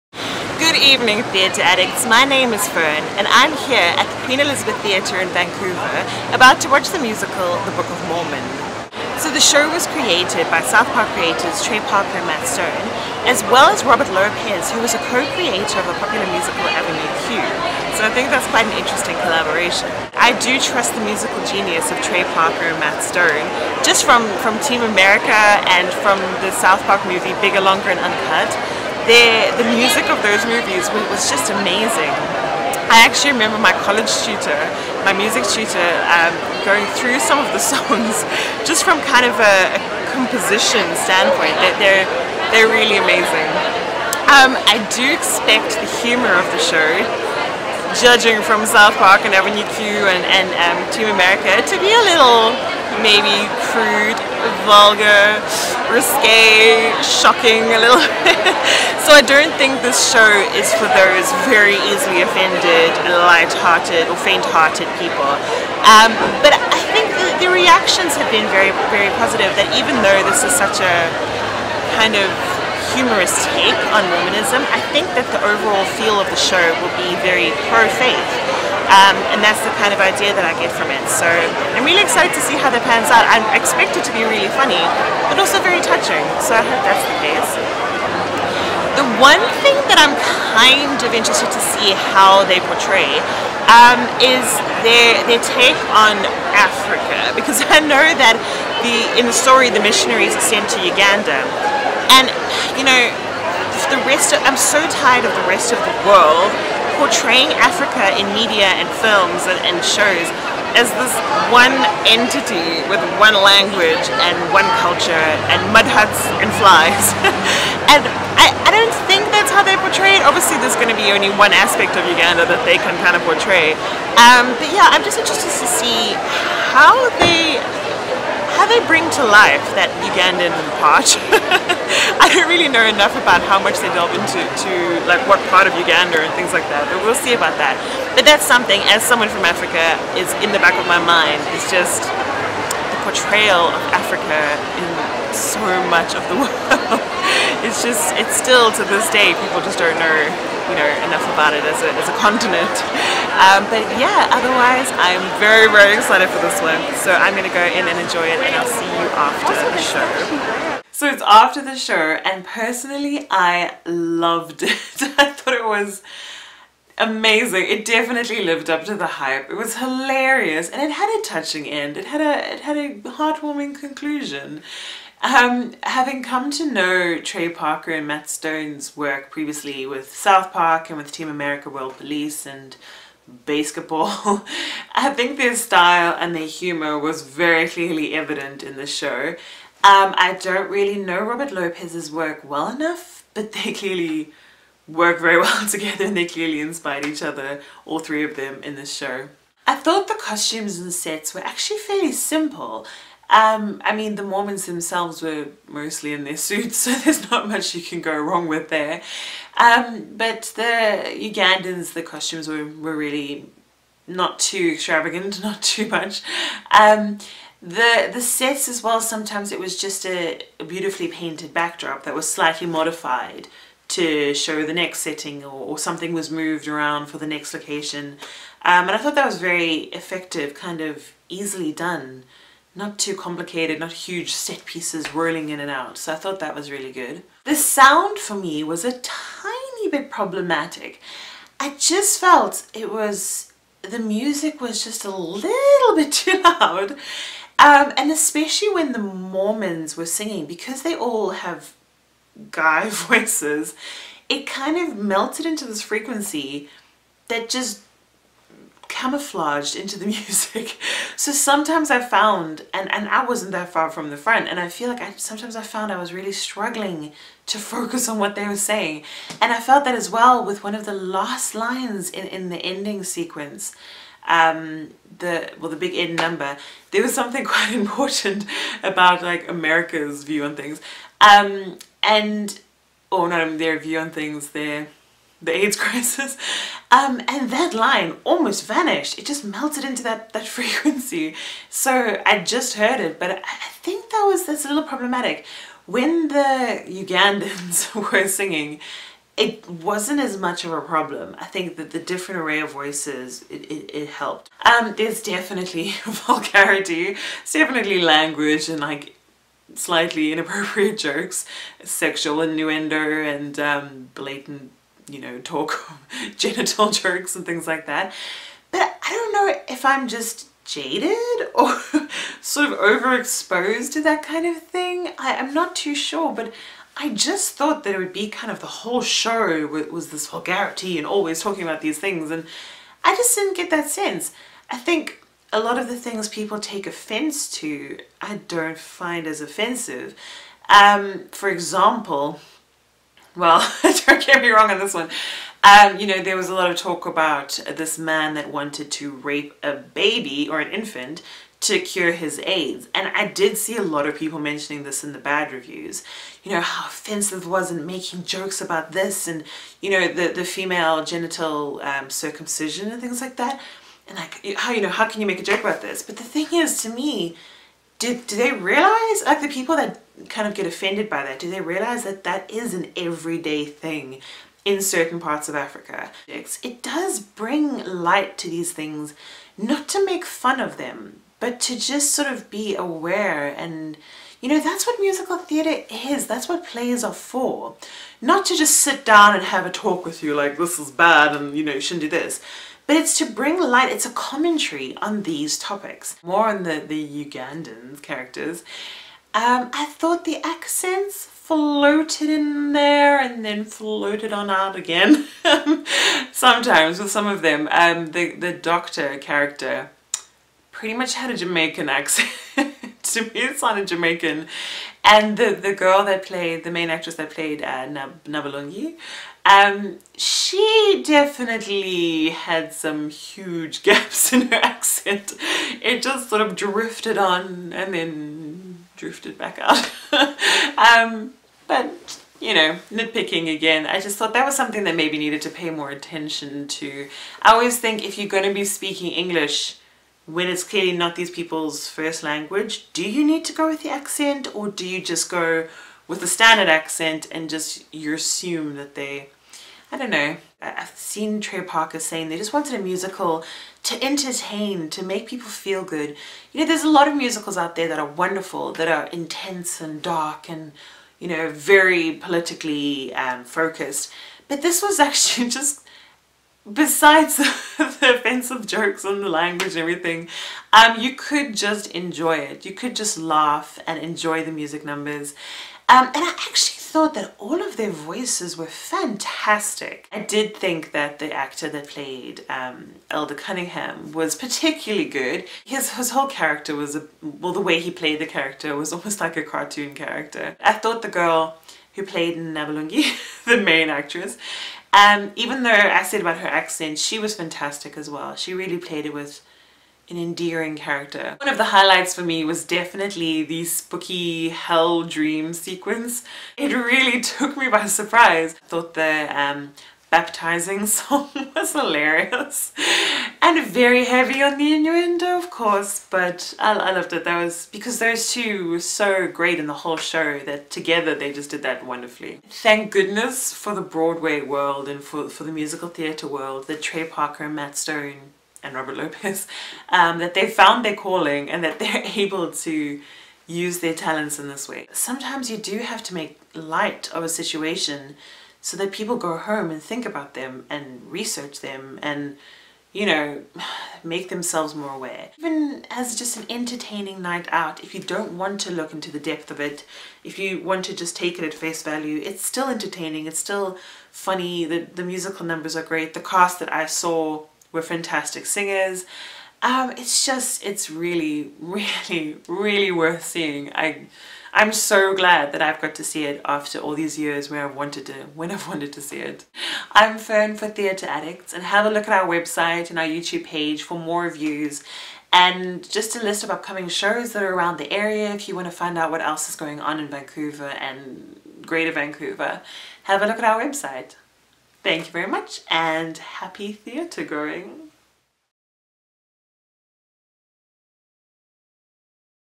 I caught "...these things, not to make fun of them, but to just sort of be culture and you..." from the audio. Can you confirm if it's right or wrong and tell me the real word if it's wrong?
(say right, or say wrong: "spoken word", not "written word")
wrong: "aware", not "culture".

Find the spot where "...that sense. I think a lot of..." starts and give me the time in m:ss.
5:33.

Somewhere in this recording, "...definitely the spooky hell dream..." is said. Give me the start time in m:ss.
8:22.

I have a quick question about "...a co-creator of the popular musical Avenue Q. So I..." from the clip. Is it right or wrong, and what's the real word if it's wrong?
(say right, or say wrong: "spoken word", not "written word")
right.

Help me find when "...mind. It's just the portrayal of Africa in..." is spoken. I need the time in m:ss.
2:21.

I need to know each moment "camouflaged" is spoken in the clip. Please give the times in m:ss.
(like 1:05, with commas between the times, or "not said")
4:18.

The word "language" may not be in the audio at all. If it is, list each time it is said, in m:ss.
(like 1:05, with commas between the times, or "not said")
1:53, 5:08, 7:22, 7:49.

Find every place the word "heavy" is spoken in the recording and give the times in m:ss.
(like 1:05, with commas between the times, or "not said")
8:34.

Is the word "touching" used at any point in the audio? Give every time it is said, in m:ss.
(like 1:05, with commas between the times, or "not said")
1:25, 2:51.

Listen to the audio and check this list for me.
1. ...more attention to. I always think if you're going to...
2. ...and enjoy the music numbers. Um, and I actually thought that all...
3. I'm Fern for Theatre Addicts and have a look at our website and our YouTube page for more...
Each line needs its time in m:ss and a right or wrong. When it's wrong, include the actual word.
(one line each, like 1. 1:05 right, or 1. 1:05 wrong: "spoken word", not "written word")
1. 7:15 right
2. 7:53 right
3. 9:29 right.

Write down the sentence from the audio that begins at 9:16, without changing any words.
The cast that I saw we're fantastic singers.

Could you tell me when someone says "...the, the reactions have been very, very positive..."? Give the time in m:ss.
1:07.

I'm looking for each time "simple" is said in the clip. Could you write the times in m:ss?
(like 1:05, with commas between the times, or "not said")
3:22.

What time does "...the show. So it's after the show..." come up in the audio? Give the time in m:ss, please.
2:39.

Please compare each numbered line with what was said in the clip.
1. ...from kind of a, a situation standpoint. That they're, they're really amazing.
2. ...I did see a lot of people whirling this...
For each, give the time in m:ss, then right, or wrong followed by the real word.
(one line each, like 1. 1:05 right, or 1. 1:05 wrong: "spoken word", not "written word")
1. 0:38 wrong: "composition", not "situation"
2. 5:53 wrong: "mentioning", not "whirling".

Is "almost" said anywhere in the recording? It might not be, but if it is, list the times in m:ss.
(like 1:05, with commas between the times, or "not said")
4:48, 8:08.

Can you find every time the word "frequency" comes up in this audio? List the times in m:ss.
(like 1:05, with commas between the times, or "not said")
4:15, 4:50.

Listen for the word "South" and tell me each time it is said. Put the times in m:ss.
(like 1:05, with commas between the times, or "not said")
0:10, 0:26, 0:48, 3:00.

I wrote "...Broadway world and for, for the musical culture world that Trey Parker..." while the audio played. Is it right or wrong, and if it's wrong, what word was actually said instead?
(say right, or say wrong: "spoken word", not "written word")
wrong: "theatre", not "culture".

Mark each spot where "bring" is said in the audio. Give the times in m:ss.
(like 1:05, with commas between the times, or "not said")
2:08, 6:17, 6:33.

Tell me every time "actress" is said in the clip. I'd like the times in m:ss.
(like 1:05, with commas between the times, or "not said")
6:56, 8:13.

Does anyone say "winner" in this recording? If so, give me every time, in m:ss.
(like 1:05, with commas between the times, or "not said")
not said.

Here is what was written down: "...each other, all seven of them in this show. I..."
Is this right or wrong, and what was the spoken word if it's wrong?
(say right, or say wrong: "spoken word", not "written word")
wrong: "three", not "seven".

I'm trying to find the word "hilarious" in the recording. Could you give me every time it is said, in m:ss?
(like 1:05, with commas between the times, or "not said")
2:49, 8:31.